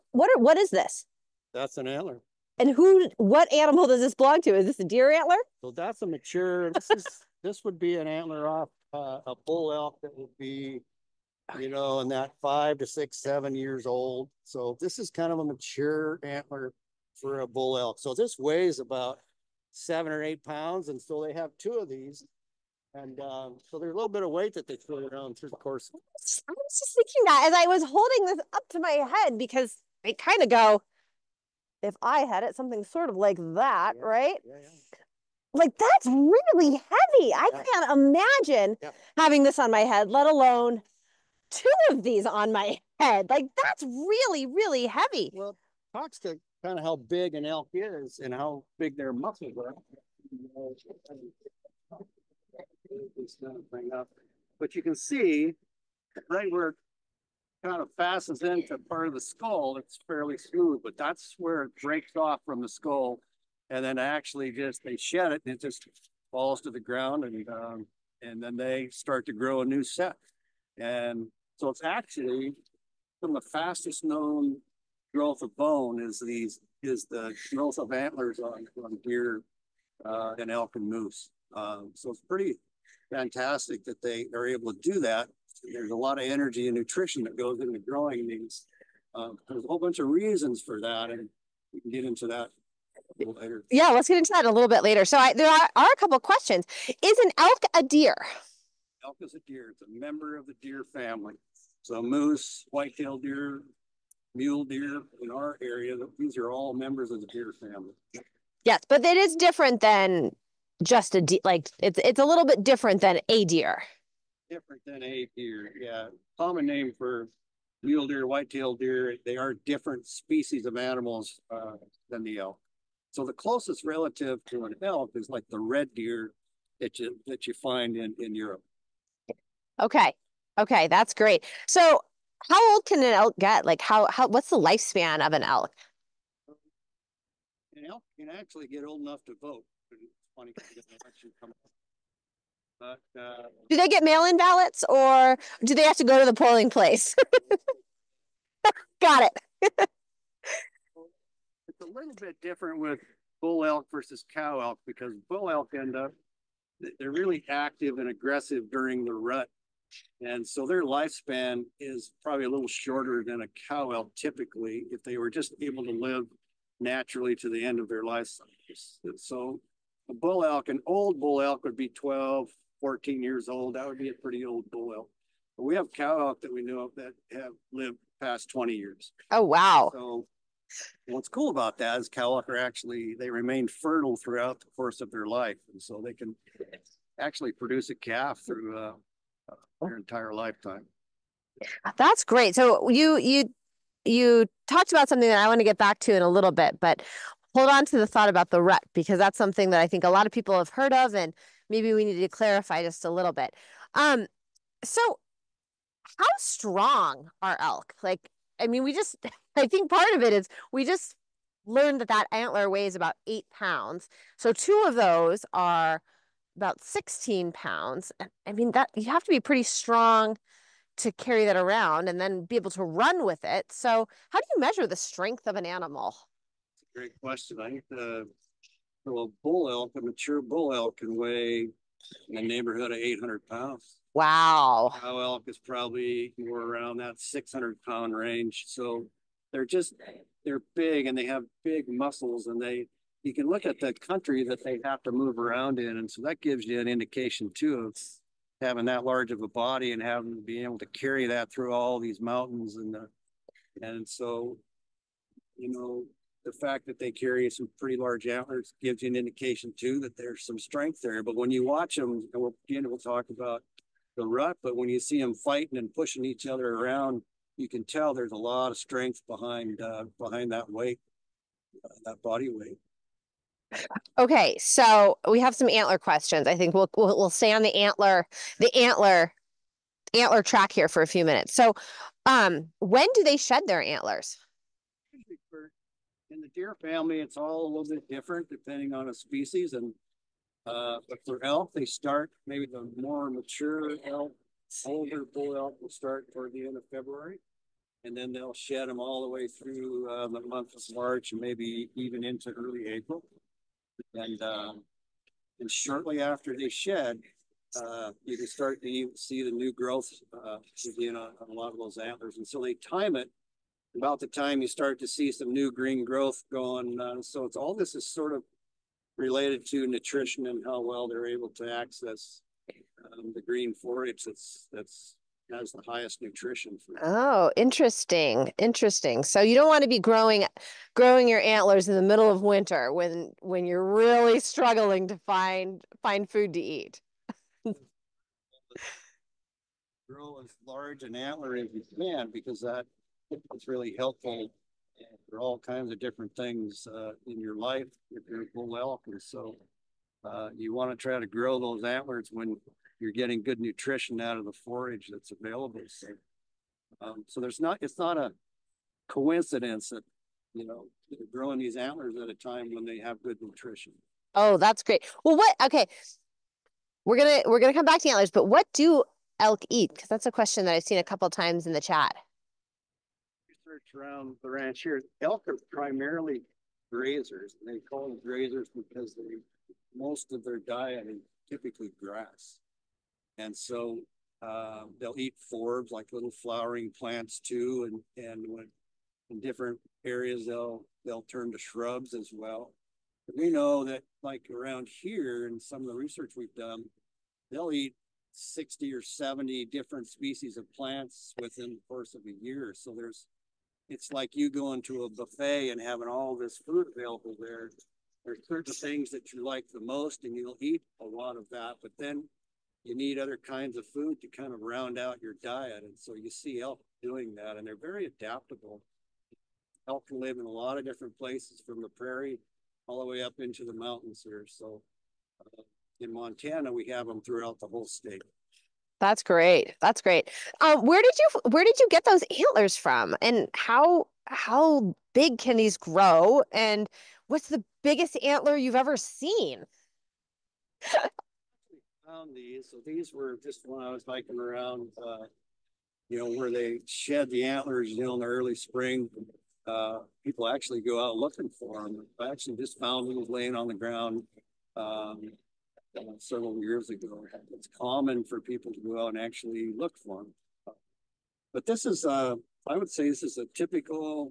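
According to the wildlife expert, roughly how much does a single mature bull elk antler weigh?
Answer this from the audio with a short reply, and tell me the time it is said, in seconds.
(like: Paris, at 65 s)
7 or 8 pounds, at 19 s.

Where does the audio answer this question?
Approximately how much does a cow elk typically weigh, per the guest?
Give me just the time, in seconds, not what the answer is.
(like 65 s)
237 s.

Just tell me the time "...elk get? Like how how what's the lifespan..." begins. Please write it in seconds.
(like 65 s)
133 s.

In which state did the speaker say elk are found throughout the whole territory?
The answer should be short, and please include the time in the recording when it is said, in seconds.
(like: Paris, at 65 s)
Montana, at 426 s.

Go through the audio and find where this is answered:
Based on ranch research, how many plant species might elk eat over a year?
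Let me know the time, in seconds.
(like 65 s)
398 s.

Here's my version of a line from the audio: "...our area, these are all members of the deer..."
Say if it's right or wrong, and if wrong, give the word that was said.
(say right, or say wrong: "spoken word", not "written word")
right.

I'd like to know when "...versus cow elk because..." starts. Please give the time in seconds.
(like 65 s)
153 s.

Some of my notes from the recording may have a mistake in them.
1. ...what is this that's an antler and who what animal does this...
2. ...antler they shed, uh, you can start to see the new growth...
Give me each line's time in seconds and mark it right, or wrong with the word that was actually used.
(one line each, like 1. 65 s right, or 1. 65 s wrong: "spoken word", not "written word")
1. 0 s right
2. 306 s wrong: "after", not "antler".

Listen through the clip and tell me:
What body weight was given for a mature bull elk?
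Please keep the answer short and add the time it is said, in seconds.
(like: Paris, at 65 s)
800 pounds, at 232 s.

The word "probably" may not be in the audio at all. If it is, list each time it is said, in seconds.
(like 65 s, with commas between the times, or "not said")
162 s, 235 s.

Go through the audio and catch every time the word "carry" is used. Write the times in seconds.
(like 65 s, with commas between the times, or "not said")
221 s, 250 s, 257 s.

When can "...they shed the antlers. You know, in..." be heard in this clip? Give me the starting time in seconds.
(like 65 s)
446 s.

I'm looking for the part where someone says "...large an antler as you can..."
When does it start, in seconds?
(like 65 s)
340 s.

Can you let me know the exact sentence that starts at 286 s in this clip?
in the deer family, it's all a little bit different depending on a species.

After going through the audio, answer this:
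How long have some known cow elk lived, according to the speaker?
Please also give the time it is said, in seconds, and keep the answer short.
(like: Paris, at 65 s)
past 20 years, at 178 s.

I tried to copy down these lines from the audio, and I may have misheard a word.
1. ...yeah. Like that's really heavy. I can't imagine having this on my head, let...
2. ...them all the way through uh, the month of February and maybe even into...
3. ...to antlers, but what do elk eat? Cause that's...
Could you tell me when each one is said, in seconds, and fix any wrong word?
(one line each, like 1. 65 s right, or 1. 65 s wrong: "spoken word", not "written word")
1. 34 s right
2. 298 s wrong: "March", not "February"
3. 368 s right.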